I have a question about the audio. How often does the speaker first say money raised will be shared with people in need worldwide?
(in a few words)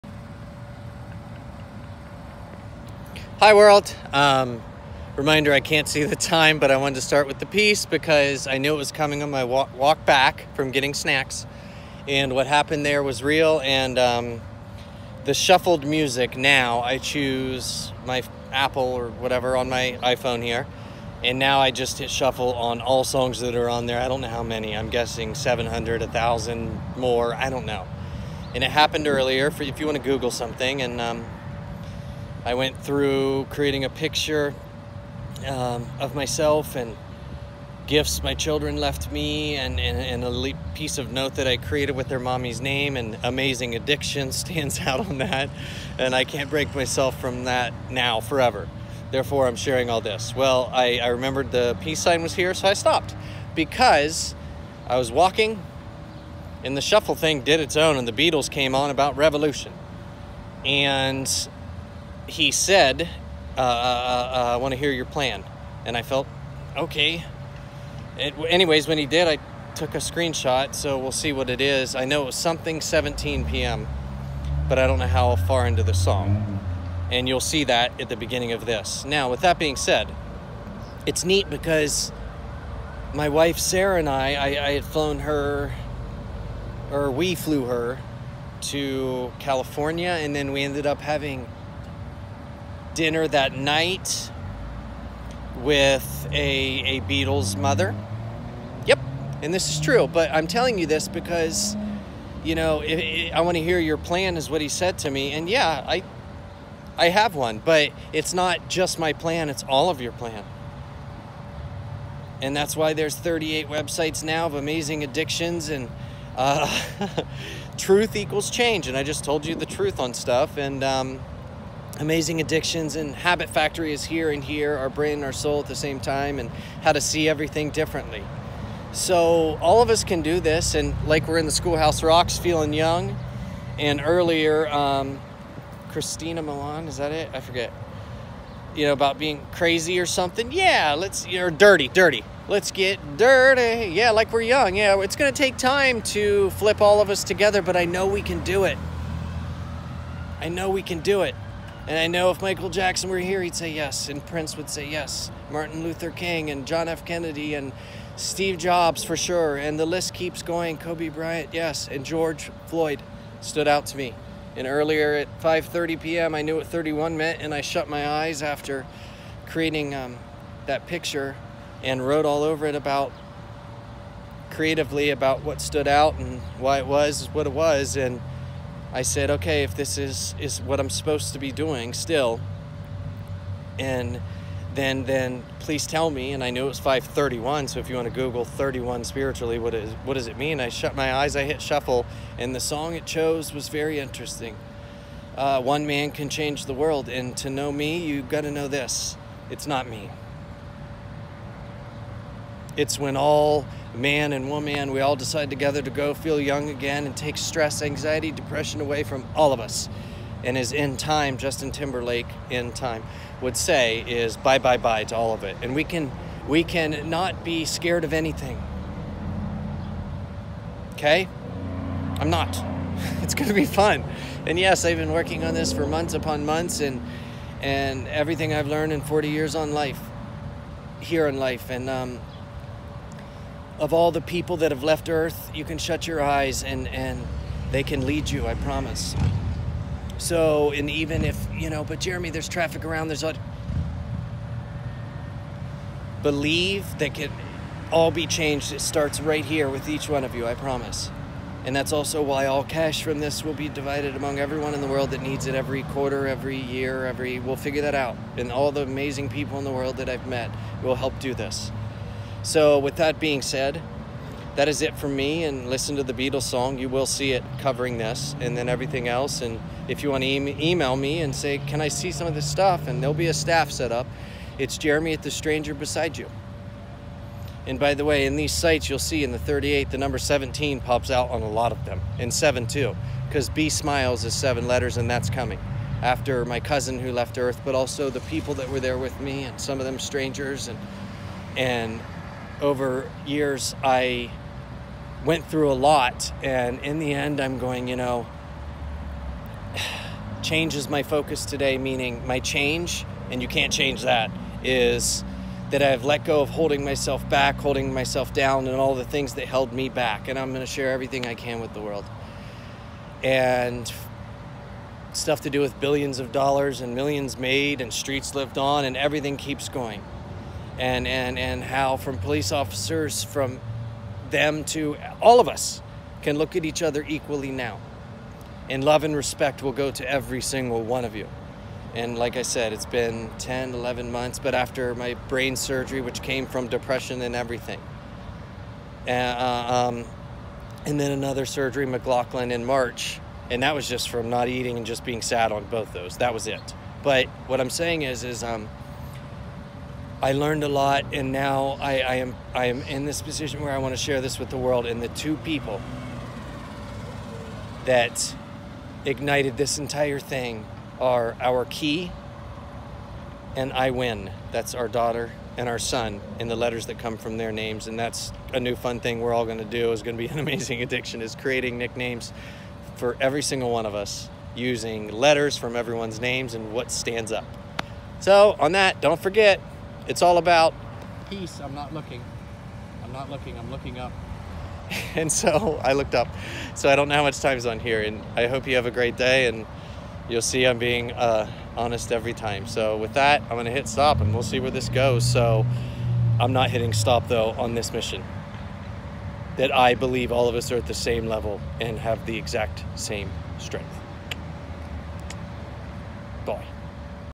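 Every quarter.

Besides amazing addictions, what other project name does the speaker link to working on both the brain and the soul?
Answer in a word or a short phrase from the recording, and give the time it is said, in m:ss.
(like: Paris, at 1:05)
Habit Factory, at 2:03.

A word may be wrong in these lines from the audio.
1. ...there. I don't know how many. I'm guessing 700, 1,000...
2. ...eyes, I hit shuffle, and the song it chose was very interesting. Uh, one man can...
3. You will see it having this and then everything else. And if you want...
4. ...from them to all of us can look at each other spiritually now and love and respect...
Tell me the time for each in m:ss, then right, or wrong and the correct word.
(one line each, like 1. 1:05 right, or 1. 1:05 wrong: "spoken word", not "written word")
1. 0:23 right
2. 3:11 right
3. 4:26 wrong: "covering", not "having"
4. 5:23 wrong: "equally", not "spiritually".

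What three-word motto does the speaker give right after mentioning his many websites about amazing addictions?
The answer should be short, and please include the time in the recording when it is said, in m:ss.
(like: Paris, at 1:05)
Truth equals change, at 1:57.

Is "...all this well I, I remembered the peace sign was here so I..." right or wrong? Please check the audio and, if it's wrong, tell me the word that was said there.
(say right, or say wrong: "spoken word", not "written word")
right.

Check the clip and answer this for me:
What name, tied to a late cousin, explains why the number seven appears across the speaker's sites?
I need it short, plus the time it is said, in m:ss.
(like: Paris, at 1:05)
B Smiles, at 4:43.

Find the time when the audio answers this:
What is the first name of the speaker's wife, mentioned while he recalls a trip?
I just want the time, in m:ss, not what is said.
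1:23.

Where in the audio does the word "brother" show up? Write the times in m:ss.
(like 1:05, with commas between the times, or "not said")
not said.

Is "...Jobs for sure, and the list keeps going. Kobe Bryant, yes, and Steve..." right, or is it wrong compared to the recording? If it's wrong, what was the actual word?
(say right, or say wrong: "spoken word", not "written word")
wrong: "George", not "Steve".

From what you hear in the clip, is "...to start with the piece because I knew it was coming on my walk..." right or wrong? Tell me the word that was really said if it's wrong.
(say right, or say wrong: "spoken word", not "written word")
right.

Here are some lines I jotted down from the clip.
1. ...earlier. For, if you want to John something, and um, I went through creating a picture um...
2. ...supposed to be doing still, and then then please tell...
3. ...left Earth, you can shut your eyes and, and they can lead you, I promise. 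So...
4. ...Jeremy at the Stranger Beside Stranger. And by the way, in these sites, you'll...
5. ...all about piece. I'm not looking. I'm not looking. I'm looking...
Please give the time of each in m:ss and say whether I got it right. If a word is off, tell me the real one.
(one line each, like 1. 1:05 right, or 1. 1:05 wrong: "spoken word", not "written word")
1. 0:29 wrong: "Google", not "John"
2. 3:00 right
3. 3:54 right
4. 4:34 wrong: "You", not "Stranger"
5. 6:20 wrong: "peace", not "piece".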